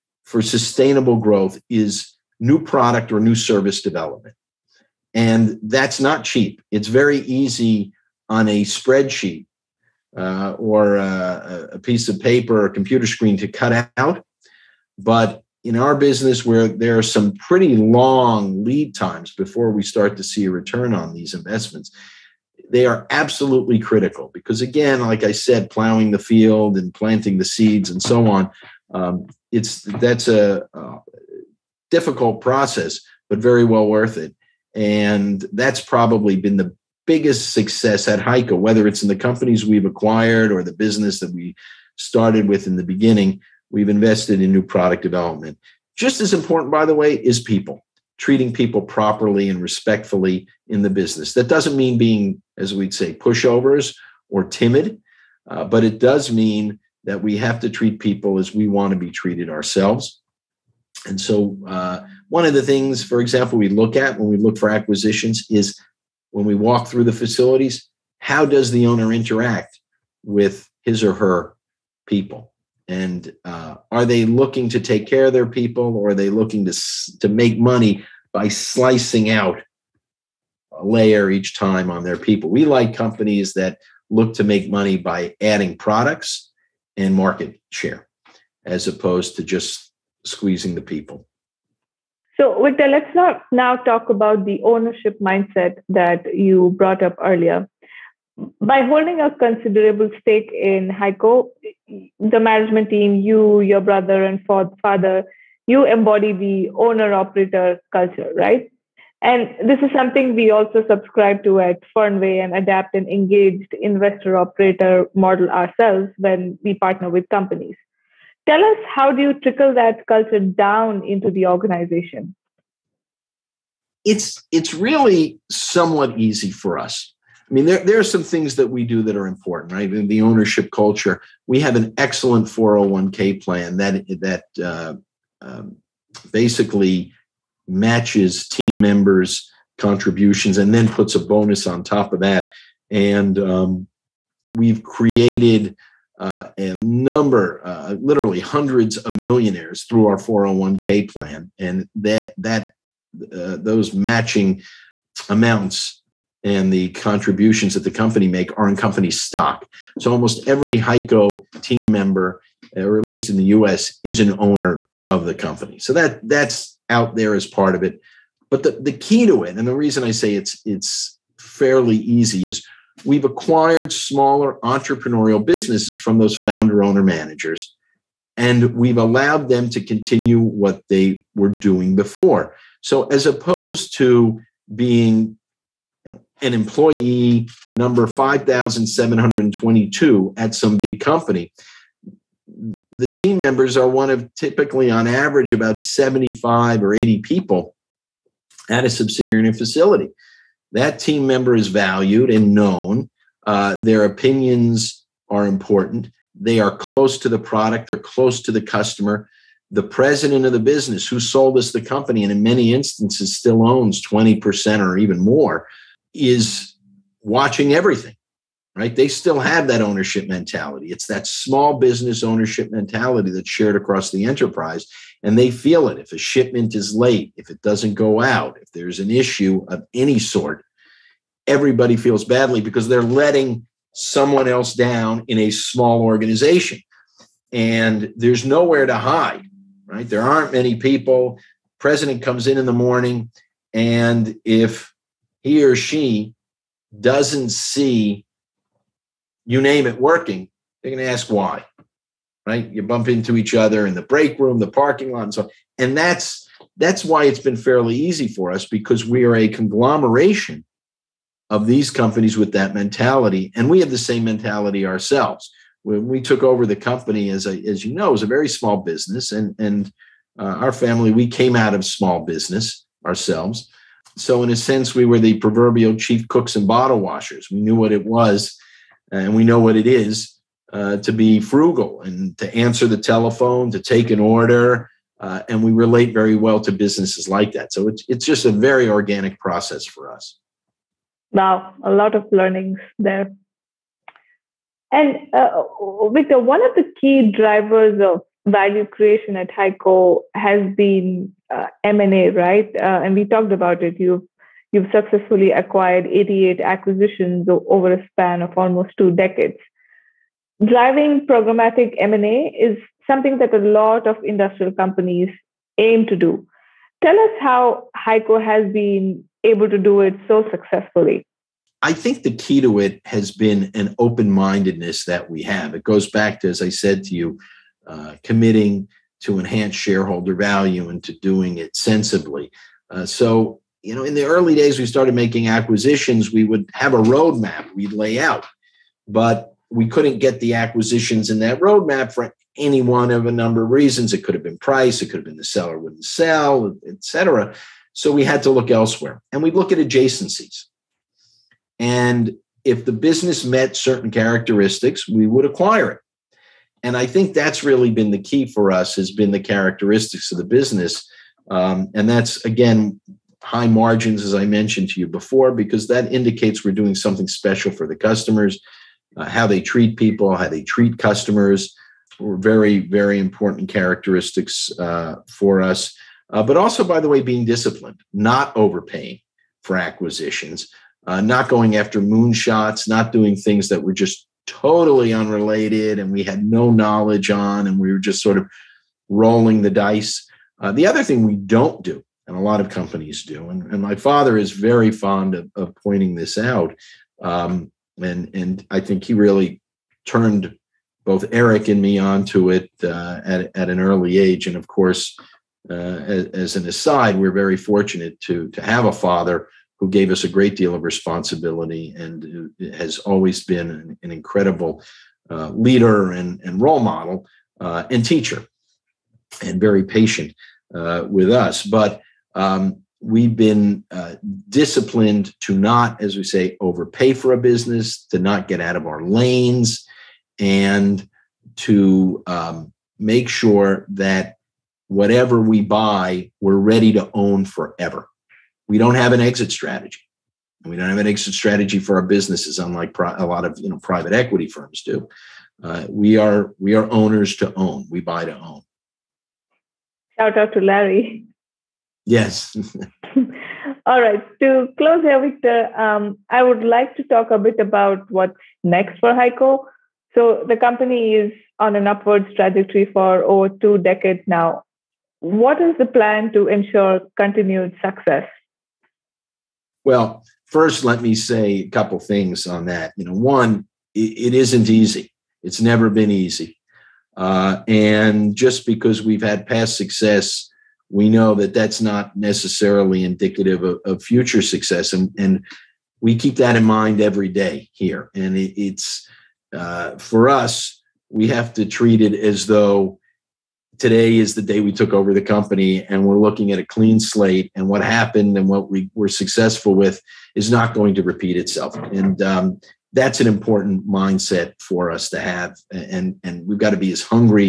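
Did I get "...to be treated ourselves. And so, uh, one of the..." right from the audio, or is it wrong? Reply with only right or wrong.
right.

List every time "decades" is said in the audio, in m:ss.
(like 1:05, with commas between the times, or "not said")
5:09, 7:43.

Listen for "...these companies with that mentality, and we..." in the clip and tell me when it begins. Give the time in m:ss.
4:21.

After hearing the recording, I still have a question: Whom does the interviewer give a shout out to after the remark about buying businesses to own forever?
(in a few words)
Larry.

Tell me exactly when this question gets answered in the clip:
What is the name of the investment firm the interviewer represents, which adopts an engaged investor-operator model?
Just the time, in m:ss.
1:51.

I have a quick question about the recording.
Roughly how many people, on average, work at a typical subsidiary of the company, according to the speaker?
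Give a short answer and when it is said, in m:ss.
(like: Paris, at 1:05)
75 or 80, at 3:15.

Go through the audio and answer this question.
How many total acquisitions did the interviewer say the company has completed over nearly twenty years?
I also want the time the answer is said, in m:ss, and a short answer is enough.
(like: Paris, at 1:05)
88, at 5:06.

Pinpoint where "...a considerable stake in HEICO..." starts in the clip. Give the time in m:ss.
1:39.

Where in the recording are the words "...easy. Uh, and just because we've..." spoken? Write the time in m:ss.
7:56.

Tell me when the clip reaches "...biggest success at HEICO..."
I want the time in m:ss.
0:37.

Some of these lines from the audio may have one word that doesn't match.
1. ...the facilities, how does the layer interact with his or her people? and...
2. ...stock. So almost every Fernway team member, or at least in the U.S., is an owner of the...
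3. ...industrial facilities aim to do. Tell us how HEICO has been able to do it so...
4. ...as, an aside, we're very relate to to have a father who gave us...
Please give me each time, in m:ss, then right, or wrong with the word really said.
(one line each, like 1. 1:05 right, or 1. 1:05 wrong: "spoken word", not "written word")
1. 1:07 wrong: "owner", not "layer"
2. 2:39 wrong: "HEICO", not "Fernway"
3. 5:14 wrong: "companies", not "facilities"
4. 6:46 wrong: "fortunate", not "relate".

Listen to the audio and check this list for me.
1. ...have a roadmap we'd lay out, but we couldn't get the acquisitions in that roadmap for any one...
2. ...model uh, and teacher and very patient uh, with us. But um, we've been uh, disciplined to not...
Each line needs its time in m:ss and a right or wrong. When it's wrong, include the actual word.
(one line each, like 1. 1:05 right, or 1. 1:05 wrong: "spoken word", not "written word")
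1. 5:36 right
2. 6:56 right.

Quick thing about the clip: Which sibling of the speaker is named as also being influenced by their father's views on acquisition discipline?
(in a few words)
Eric.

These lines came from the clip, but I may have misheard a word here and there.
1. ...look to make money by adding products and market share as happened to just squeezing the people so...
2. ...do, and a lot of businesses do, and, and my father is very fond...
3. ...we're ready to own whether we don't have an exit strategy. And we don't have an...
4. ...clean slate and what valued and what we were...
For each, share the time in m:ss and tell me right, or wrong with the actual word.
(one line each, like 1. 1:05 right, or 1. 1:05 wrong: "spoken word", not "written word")
1. 1:24 wrong: "opposed", not "happened"
2. 6:31 wrong: "companies", not "businesses"
3. 7:16 wrong: "forever", not "whether"
4. 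8:16 wrong: "happened", not "valued".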